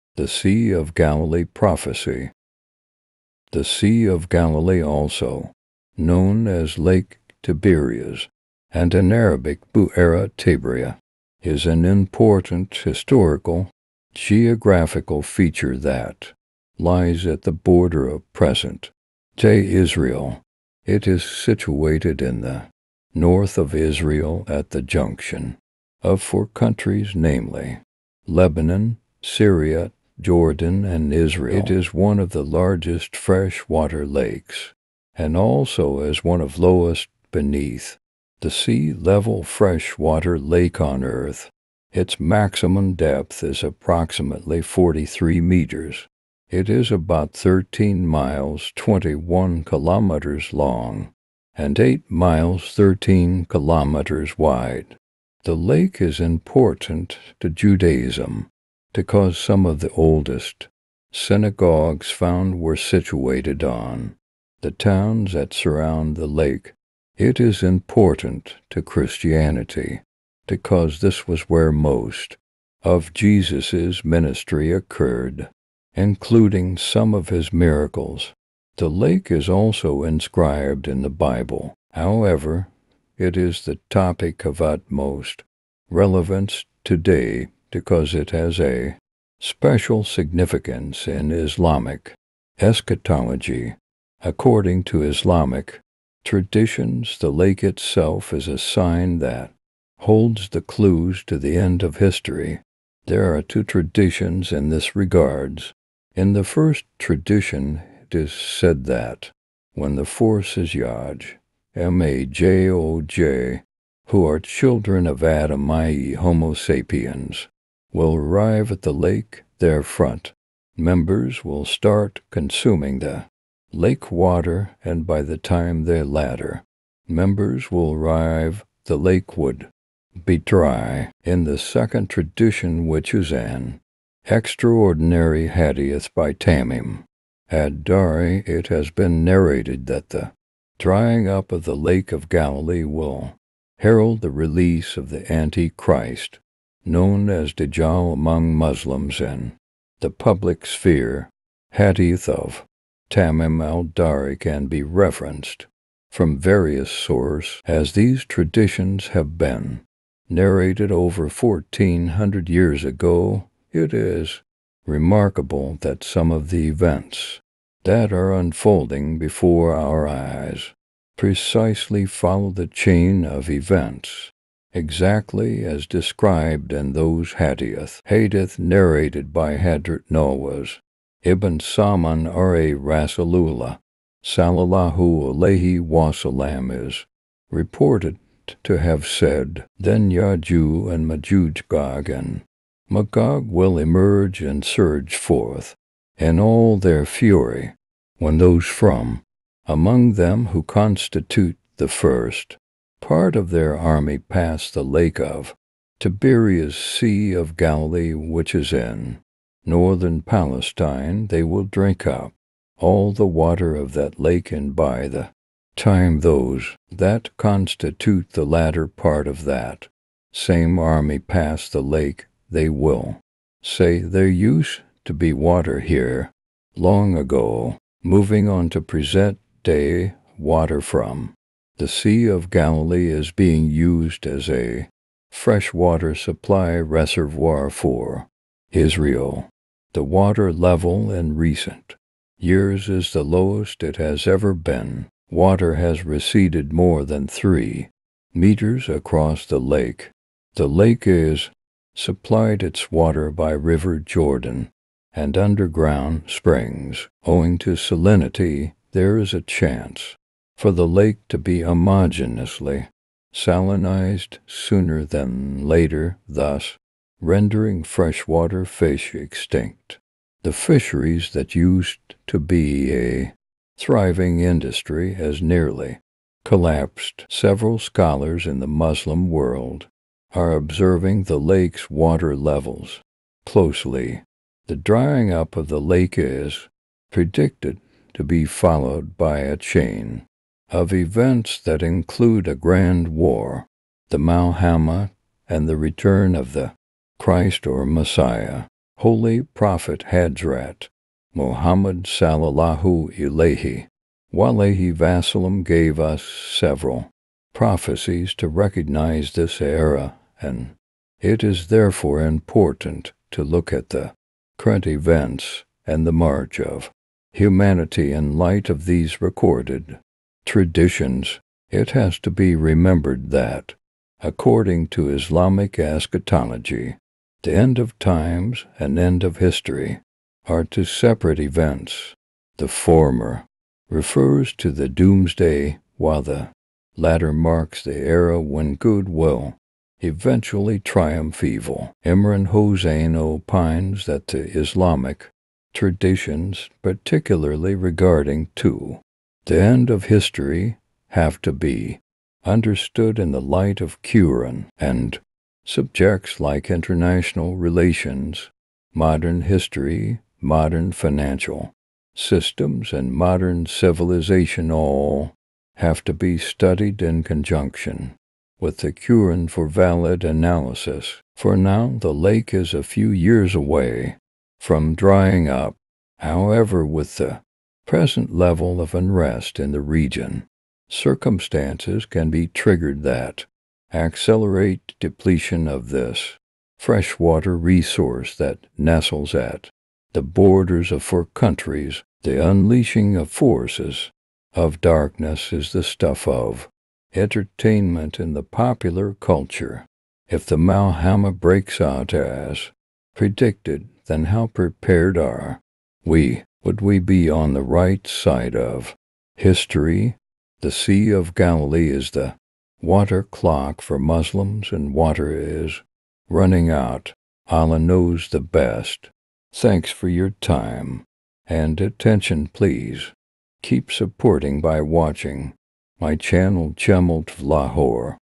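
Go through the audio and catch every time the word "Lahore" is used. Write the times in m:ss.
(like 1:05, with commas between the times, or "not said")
7:07.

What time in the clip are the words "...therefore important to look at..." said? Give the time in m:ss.
5:11.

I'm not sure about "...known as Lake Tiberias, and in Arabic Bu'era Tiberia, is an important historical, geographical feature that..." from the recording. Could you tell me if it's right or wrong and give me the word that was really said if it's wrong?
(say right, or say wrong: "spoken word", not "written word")
right.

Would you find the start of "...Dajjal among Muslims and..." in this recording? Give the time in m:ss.
2:27.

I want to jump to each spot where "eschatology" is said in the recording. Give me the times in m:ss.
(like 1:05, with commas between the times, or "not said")
1:32, 5:25.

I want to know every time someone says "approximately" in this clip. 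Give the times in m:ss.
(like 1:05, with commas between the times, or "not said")
0:43.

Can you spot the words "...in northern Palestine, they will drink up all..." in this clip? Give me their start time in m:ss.
3:28.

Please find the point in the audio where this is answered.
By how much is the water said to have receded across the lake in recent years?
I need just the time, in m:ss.
4:06.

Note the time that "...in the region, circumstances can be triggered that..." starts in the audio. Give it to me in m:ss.
6:19.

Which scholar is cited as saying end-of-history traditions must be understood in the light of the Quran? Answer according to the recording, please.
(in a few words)
Imran Hosein.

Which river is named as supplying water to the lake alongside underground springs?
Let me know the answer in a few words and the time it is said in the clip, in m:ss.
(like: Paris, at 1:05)
River Jordan, at 4:13.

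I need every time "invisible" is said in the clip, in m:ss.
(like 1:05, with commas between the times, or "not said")
not said.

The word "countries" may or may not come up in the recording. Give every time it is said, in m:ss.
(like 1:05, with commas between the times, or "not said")
0:26, 6:31.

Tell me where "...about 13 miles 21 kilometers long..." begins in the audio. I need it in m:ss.
0:46.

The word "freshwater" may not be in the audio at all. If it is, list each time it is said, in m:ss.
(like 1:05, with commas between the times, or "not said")
0:33, 0:39, 3:55, 4:27, 6:26.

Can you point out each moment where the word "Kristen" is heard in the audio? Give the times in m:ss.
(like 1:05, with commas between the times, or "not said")
not said.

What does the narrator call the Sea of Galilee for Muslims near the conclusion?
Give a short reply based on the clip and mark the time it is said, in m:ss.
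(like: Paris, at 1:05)
the water clock, at 6:52.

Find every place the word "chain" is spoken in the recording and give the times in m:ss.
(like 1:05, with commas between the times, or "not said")
2:52, 4:49.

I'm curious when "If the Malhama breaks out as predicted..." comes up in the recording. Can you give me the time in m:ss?
6:40.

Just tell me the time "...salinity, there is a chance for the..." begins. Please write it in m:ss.
4:17.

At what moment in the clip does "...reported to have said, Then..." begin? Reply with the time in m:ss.
3:07.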